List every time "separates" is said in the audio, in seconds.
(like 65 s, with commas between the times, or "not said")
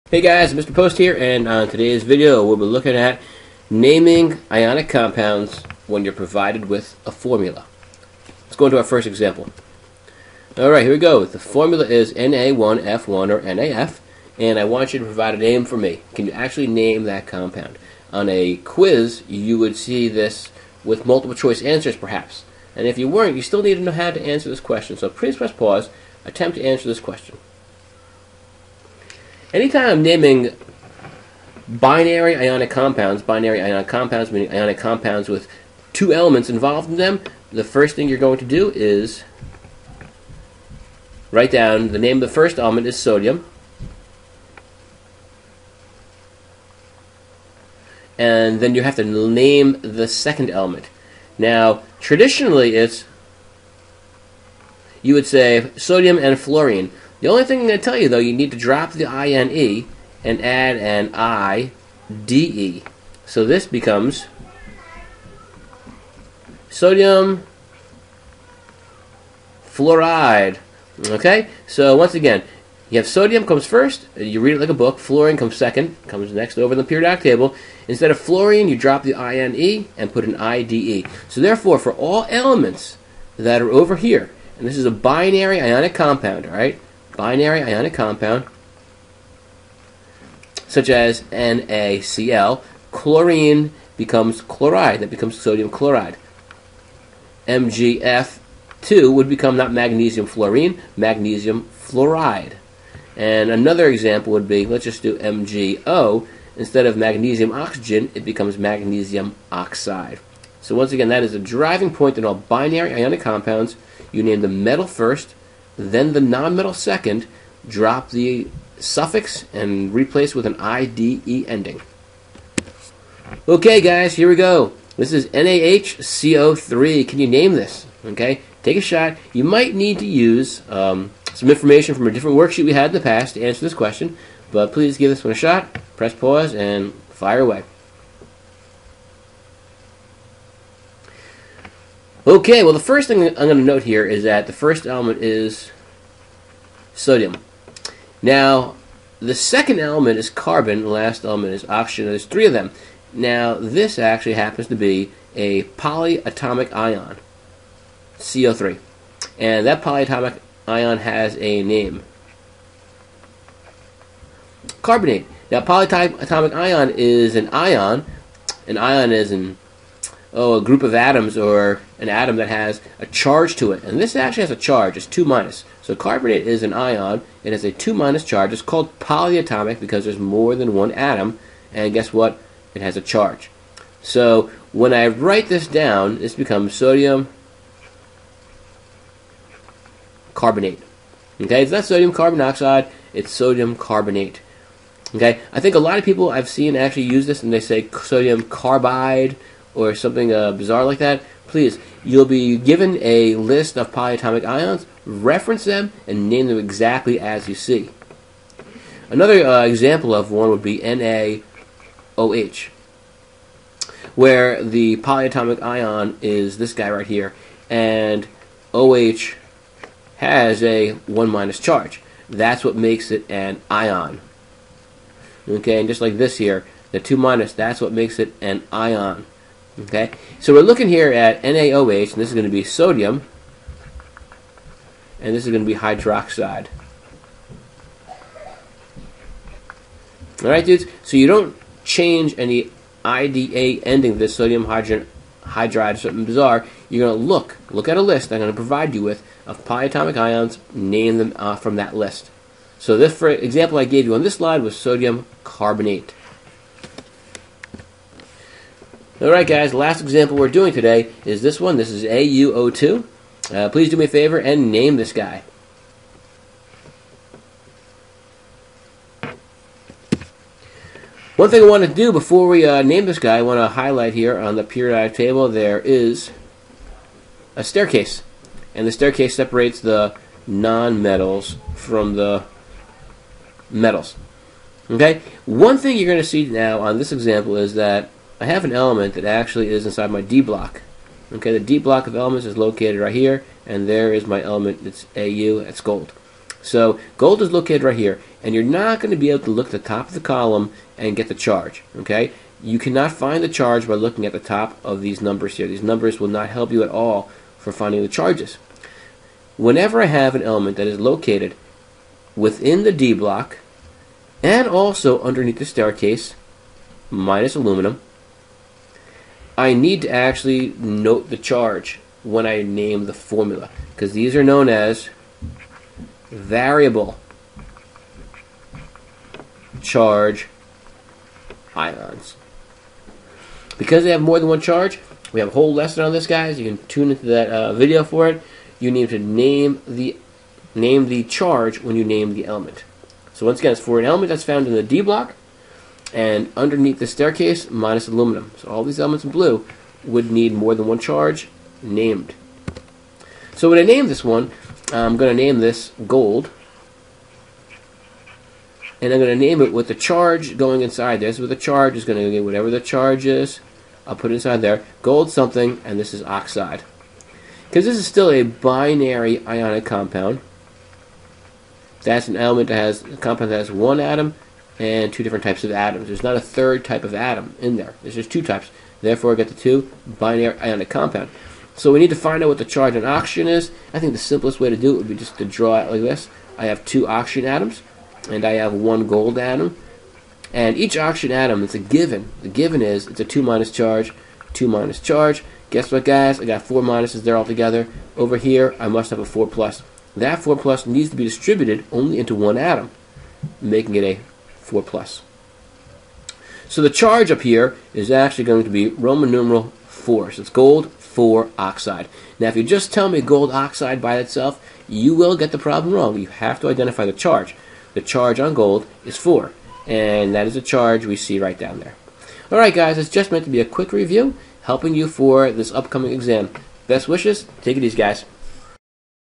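279 s.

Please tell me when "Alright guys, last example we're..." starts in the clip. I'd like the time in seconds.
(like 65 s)
259 s.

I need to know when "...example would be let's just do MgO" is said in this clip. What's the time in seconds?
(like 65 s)
103 s.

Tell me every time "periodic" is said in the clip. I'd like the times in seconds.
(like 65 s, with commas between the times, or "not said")
76 s, 274 s.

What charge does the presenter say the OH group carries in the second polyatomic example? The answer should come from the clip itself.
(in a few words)
1 minus.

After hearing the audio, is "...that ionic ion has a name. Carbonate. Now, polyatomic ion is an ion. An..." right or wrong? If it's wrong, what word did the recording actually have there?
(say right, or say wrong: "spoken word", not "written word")
wrong: "polyatomic", not "ionic".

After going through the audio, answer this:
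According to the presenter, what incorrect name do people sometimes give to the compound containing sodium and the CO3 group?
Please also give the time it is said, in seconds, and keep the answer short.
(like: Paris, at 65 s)
sodium carbide, at 197 s.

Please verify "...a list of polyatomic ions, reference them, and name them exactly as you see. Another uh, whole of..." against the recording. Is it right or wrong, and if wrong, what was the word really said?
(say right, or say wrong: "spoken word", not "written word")
wrong: "example", not "whole".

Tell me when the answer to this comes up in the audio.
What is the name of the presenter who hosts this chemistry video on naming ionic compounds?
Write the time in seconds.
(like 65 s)
0 s.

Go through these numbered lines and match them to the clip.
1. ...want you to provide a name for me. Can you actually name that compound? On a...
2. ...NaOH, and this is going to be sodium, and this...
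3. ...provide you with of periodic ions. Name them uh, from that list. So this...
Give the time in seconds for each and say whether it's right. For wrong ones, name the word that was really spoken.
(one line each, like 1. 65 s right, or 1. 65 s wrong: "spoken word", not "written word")
1. 14 s right
2. 231 s right
3. 248 s wrong: "polyatomic", not "periodic".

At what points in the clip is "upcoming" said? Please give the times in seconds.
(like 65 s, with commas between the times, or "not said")
425 s.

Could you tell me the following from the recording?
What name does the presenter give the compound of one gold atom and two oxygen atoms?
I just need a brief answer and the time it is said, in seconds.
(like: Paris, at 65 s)
gold 4 oxide, at 410 s.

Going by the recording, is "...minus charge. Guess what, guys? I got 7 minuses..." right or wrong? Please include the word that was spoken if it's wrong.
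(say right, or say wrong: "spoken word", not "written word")
wrong: "4", not "7".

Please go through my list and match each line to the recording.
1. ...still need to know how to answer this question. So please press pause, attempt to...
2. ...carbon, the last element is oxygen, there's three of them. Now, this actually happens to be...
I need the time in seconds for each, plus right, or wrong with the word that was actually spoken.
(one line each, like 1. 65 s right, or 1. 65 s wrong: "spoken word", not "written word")
1. 23 s right
2. 150 s right.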